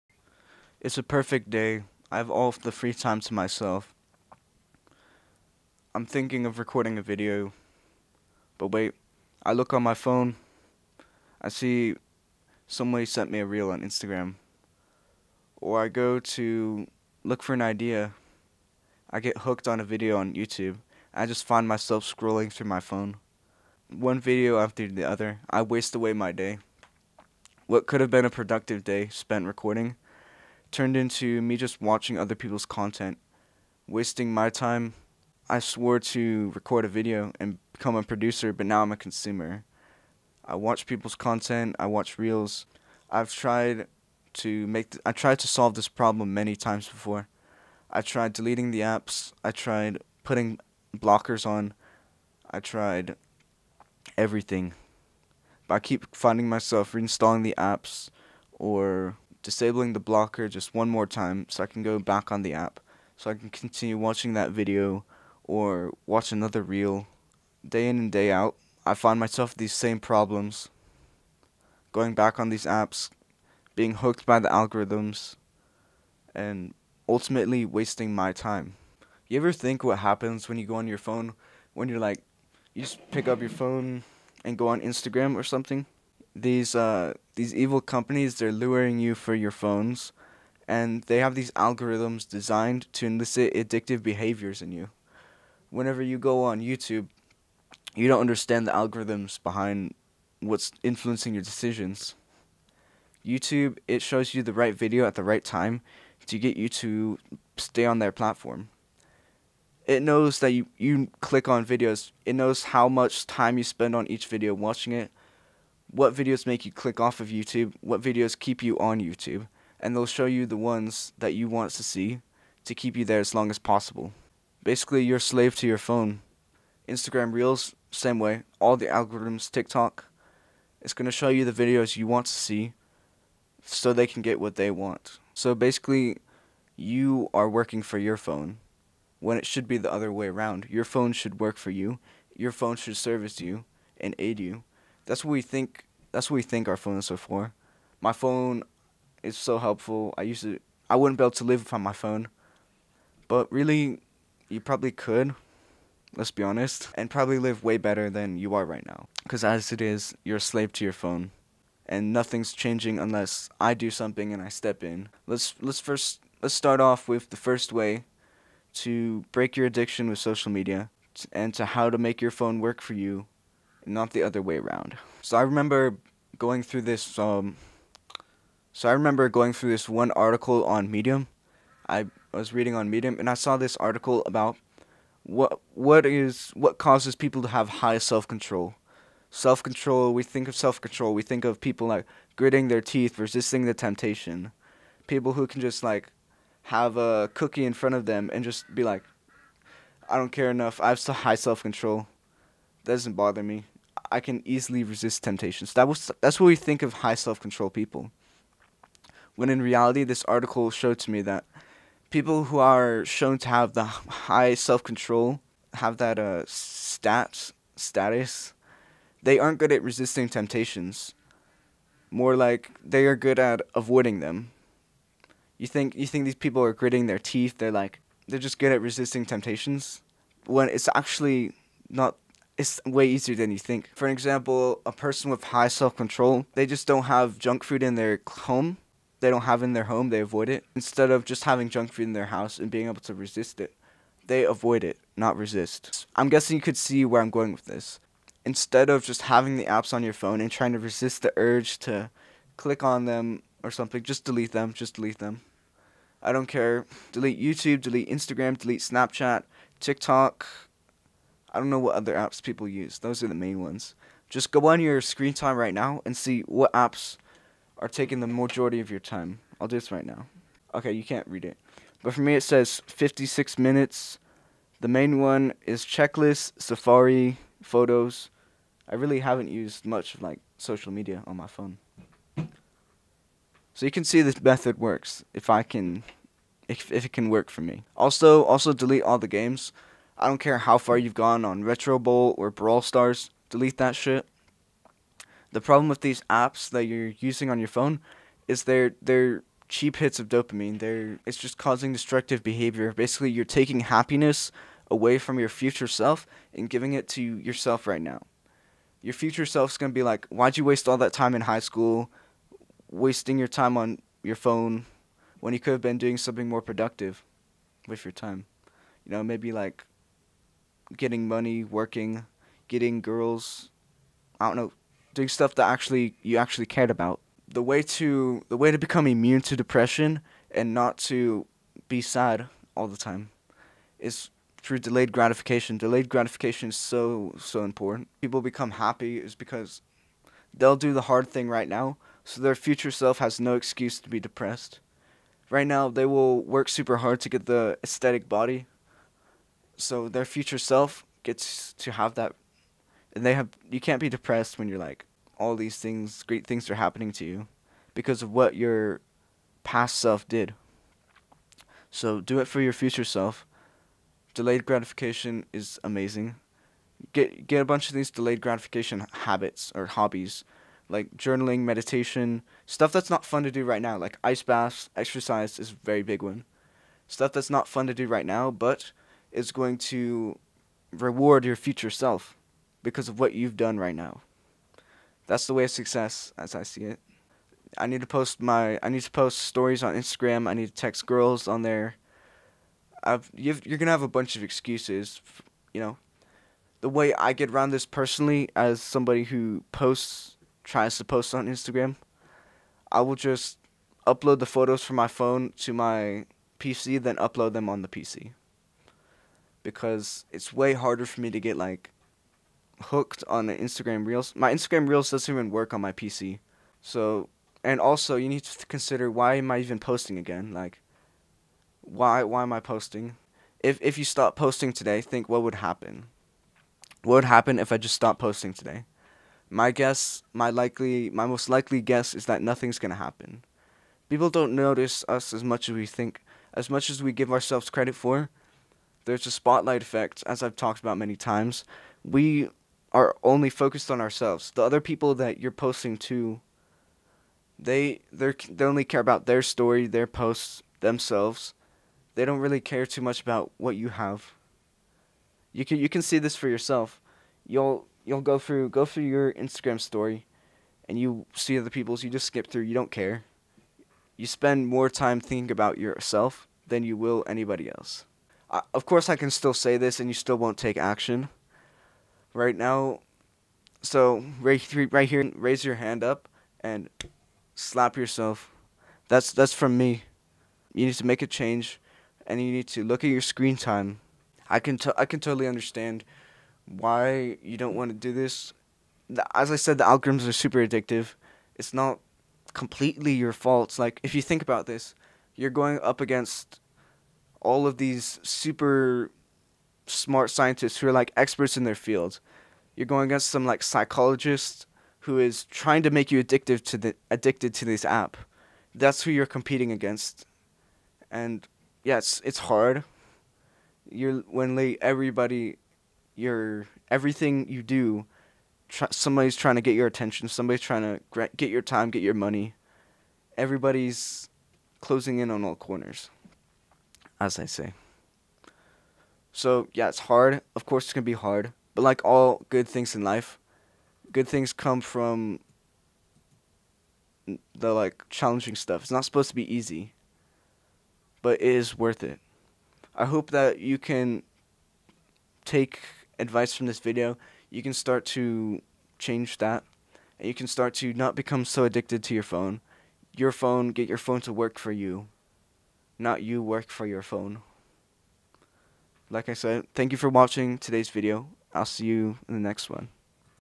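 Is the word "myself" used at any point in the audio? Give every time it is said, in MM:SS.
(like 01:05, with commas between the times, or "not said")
00:03, 00:21, 00:56, 01:09.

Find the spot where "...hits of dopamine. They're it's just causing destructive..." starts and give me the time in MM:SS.
04:59.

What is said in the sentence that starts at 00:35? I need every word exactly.
I swore to record a video and become a producer, but now I'm a consumer.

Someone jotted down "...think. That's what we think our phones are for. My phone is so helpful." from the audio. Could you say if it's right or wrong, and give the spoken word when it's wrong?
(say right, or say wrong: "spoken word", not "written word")
right.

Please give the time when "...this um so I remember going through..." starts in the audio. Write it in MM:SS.
02:56.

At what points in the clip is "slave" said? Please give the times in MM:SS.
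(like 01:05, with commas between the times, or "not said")
02:05, 02:40.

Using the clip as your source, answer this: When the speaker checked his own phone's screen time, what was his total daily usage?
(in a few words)
56 minutes.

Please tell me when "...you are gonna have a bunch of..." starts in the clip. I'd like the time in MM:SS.
06:33.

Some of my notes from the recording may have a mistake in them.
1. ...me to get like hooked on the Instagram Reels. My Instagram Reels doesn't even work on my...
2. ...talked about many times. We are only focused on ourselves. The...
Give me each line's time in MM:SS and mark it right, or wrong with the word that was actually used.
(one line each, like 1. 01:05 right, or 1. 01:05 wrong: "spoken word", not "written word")
1. 06:51 right
2. 07:20 right.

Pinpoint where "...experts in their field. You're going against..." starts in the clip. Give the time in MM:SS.
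08:21.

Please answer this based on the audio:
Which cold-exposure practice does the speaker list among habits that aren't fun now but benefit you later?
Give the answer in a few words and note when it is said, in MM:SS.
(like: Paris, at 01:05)
Ice baths, at 06:14.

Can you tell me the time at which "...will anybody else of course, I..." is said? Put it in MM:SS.
07:46.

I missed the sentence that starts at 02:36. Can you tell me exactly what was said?
Let's be honest, and probably live way better than you are right now.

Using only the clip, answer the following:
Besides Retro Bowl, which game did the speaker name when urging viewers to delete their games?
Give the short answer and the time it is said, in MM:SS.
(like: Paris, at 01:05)
Brawl Stars, at 04:52.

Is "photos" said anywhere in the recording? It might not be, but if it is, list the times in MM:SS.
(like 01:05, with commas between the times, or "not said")
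04:37, 06:44.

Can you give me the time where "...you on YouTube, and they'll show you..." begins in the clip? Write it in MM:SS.
01:58.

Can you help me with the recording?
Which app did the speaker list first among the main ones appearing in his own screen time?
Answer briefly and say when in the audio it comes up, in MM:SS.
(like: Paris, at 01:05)
Checklist, at 04:35.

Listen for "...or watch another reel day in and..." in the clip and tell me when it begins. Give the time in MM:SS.
01:05.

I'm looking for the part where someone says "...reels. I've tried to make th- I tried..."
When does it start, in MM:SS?
00:42.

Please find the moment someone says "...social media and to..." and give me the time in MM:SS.
02:50.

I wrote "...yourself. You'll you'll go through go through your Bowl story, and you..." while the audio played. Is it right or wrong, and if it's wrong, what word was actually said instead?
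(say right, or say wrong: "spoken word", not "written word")
wrong: "Instagram", not "Bowl".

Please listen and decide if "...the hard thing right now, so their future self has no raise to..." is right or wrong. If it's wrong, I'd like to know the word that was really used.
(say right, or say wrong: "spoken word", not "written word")
wrong: "excuse", not "raise".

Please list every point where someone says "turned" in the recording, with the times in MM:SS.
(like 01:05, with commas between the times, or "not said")
00:30.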